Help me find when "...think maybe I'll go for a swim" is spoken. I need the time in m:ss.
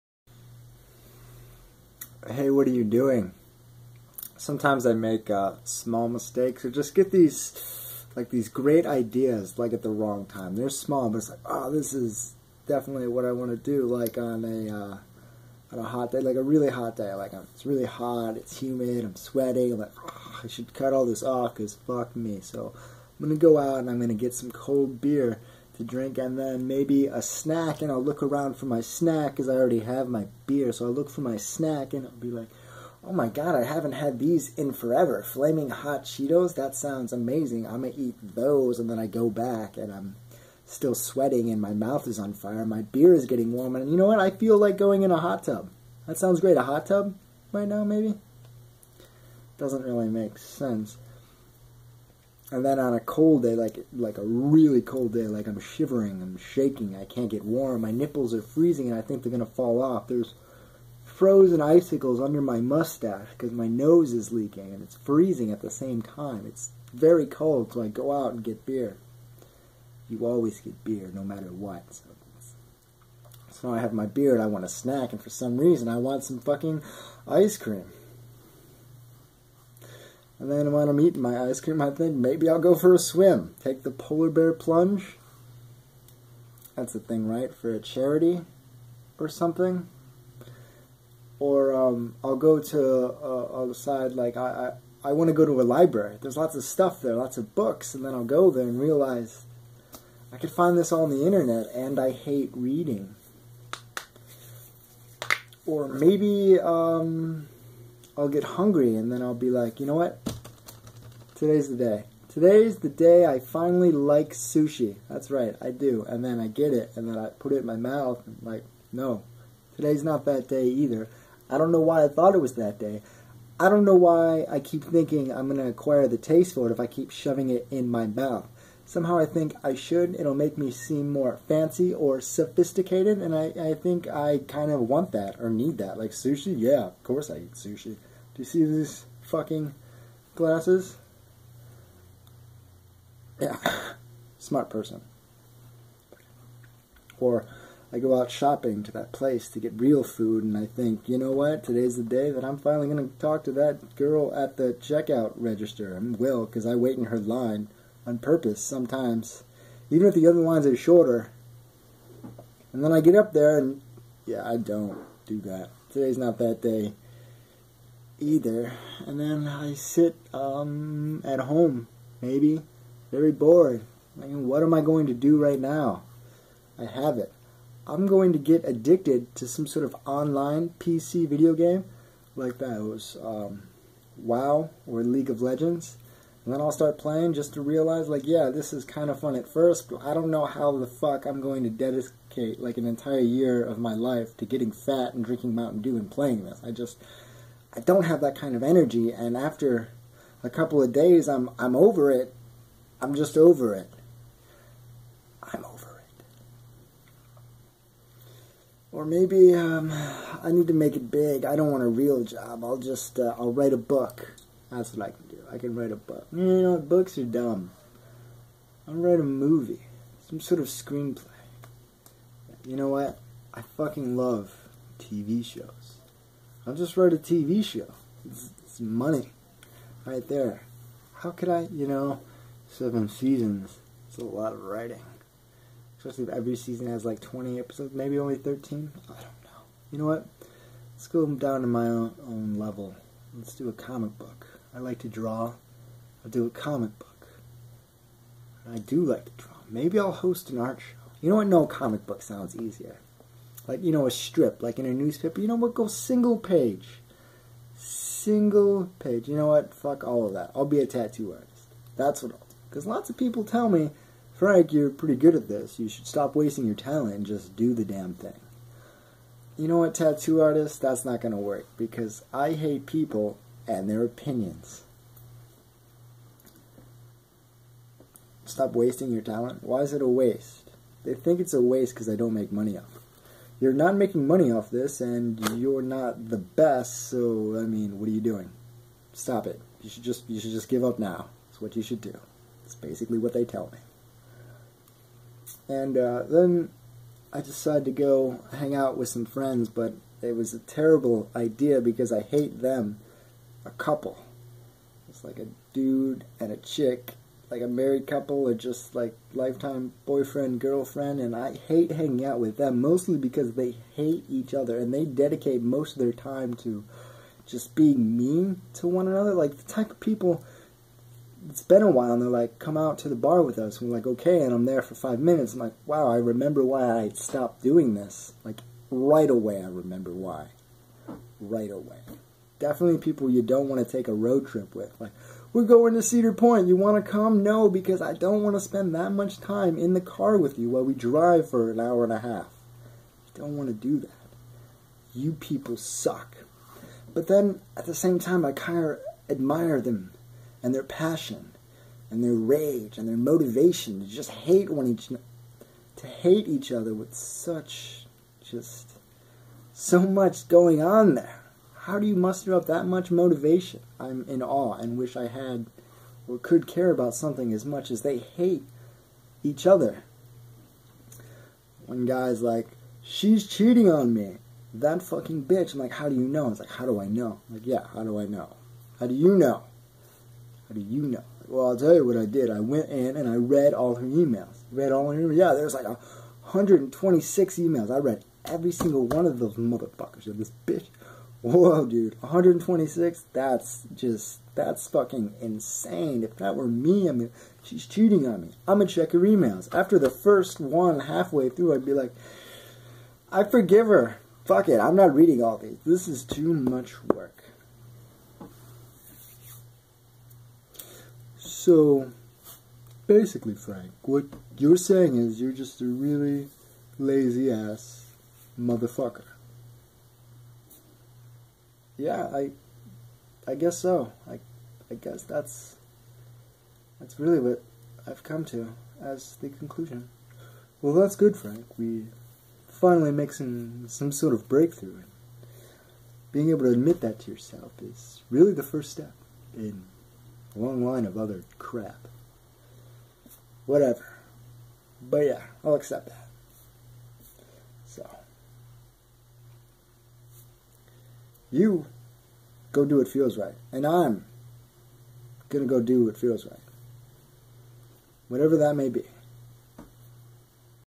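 1:21.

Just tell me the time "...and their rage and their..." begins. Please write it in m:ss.
5:52.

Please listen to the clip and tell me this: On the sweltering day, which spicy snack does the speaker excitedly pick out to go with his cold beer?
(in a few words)
Flaming hot Cheetos.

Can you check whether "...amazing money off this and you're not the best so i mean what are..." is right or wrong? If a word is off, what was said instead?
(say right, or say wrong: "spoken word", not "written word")
wrong: "making", not "amazing".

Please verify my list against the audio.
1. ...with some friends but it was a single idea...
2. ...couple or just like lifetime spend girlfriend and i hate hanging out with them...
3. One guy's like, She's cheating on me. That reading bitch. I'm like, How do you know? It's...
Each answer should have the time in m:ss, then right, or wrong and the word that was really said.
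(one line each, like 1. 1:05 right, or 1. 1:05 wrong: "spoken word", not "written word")
1. 4:58 wrong: "terrible", not "single"
2. 5:08 wrong: "boyfriend", not "spend"
3. 6:11 wrong: "fucking", not "reading".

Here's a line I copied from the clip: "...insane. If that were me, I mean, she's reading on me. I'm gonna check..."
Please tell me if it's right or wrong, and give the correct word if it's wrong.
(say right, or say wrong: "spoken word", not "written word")
wrong: "cheating", not "reading".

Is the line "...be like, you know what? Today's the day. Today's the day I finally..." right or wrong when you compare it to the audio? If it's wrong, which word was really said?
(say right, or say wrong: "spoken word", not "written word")
right.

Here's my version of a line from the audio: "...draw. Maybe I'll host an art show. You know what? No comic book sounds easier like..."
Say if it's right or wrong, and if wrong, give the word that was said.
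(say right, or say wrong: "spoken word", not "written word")
right.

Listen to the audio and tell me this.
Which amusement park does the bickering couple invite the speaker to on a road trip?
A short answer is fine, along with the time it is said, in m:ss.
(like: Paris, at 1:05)
Cedar Point, at 5:36.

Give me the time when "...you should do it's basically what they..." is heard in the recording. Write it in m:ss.
4:51.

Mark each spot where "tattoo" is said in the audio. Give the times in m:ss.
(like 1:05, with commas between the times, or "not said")
4:20, 4:29.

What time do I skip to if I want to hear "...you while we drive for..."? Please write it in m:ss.
5:40.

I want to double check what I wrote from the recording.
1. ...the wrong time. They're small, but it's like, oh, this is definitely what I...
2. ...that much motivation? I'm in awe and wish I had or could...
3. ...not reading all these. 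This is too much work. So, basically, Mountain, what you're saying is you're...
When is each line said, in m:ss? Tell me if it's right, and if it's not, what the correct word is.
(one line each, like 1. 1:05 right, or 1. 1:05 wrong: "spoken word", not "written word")
1. 0:09 right
2. 6:02 right
3. 6:44 wrong: "Frank", not "Mountain".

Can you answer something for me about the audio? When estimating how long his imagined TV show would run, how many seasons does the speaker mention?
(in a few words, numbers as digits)
7.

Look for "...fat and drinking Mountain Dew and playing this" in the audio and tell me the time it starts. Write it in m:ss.
3:14.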